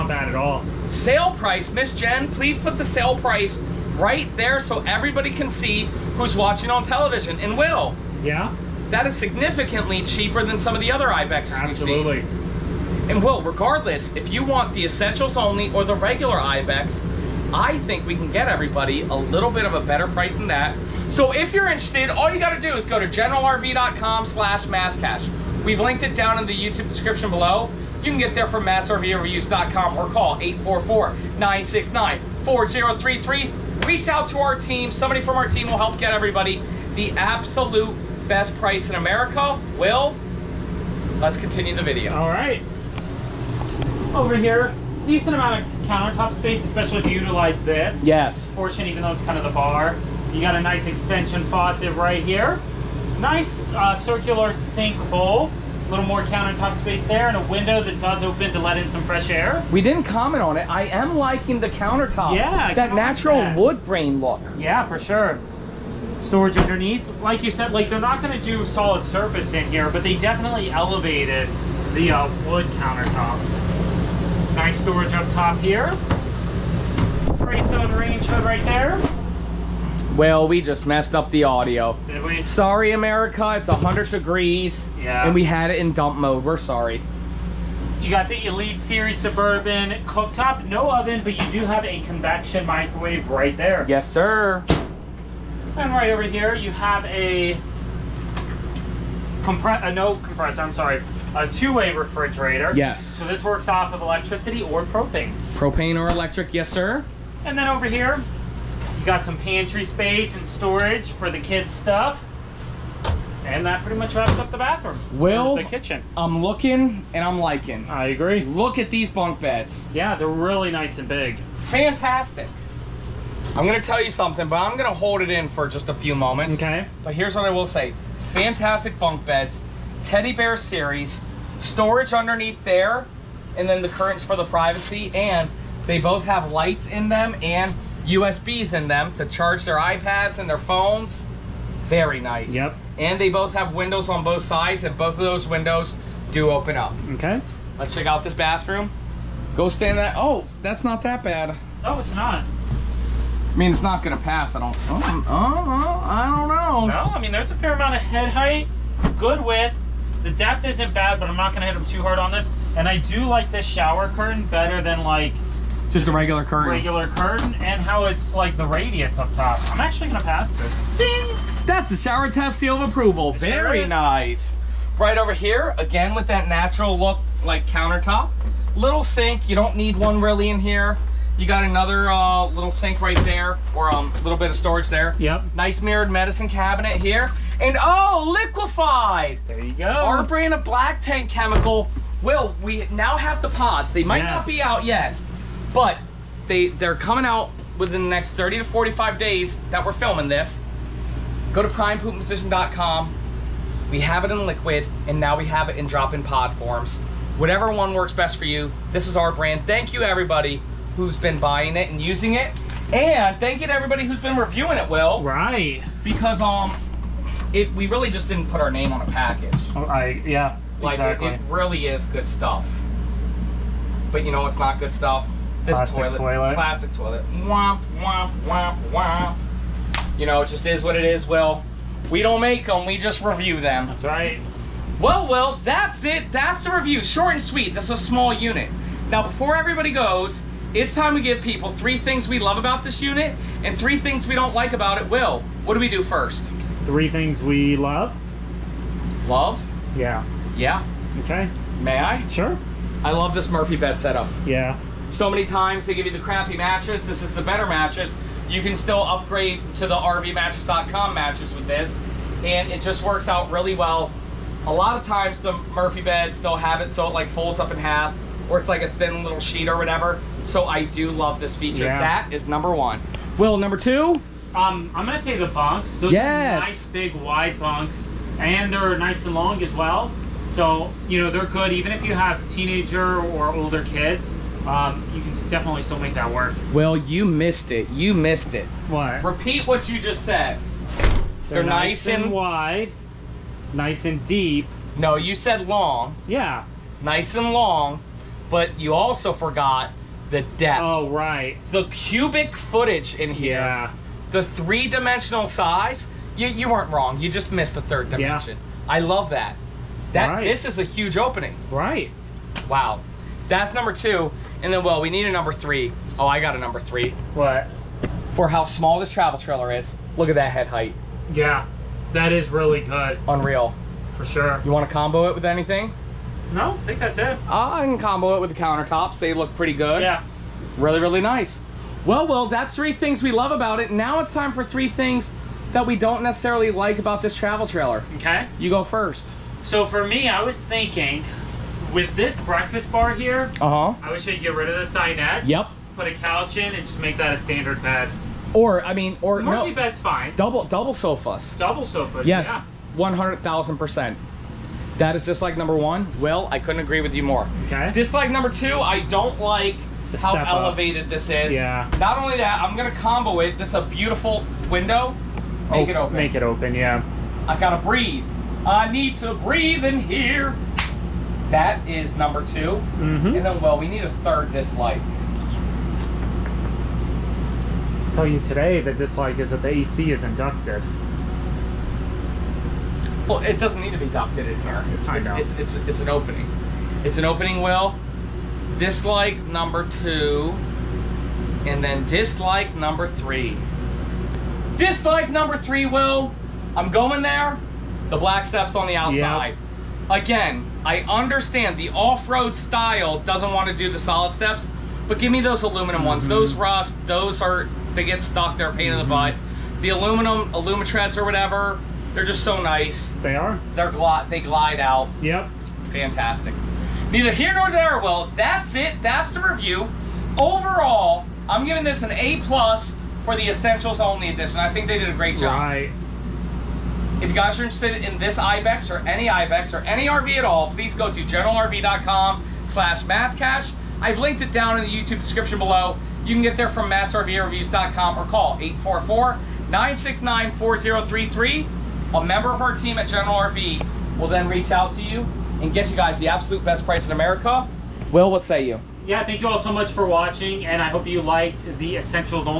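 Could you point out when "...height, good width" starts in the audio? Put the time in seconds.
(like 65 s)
158 s.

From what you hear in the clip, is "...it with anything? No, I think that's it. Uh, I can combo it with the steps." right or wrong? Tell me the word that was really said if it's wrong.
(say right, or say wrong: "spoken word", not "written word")
wrong: "countertops", not "steps".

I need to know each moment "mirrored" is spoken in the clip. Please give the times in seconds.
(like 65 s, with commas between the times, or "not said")
185 s.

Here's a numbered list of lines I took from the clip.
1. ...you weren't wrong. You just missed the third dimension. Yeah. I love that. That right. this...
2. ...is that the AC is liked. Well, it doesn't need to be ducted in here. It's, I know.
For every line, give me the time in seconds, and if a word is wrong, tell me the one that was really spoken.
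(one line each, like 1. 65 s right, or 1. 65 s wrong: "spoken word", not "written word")
1. 306 s right
2. 379 s wrong: "inducted", not "liked".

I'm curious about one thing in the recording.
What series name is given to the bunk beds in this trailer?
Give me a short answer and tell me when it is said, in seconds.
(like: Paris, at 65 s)
Teddy bear series, at 130 s.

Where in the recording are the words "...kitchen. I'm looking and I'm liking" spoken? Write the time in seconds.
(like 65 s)
115 s.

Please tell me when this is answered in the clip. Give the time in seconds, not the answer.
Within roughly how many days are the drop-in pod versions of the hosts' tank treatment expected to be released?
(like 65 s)
198 s.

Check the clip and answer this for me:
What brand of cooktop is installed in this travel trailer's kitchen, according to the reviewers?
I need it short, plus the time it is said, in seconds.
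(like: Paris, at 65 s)
Elite Series Suburban, at 88 s.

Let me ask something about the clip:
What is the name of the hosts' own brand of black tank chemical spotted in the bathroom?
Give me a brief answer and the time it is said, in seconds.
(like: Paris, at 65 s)
Liquified, at 188 s.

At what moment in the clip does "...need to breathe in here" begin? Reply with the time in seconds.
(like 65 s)
368 s.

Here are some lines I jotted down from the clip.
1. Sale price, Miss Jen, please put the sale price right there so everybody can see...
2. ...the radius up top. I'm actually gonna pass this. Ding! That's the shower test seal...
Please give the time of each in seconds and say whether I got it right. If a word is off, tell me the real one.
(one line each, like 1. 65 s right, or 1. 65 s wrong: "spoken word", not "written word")
1. 0 s right
2. 168 s right.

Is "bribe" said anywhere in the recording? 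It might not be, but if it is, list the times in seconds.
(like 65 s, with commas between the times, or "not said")
not said.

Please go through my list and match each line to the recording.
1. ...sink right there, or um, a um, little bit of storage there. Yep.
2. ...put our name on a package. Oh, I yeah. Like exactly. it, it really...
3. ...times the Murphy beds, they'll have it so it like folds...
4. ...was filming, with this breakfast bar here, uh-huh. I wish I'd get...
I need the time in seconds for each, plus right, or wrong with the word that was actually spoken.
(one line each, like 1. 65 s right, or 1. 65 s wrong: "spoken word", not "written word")
1. 182 s right
2. 218 s right
3. 265 s right
4. 340 s wrong: "thinking", not "filming".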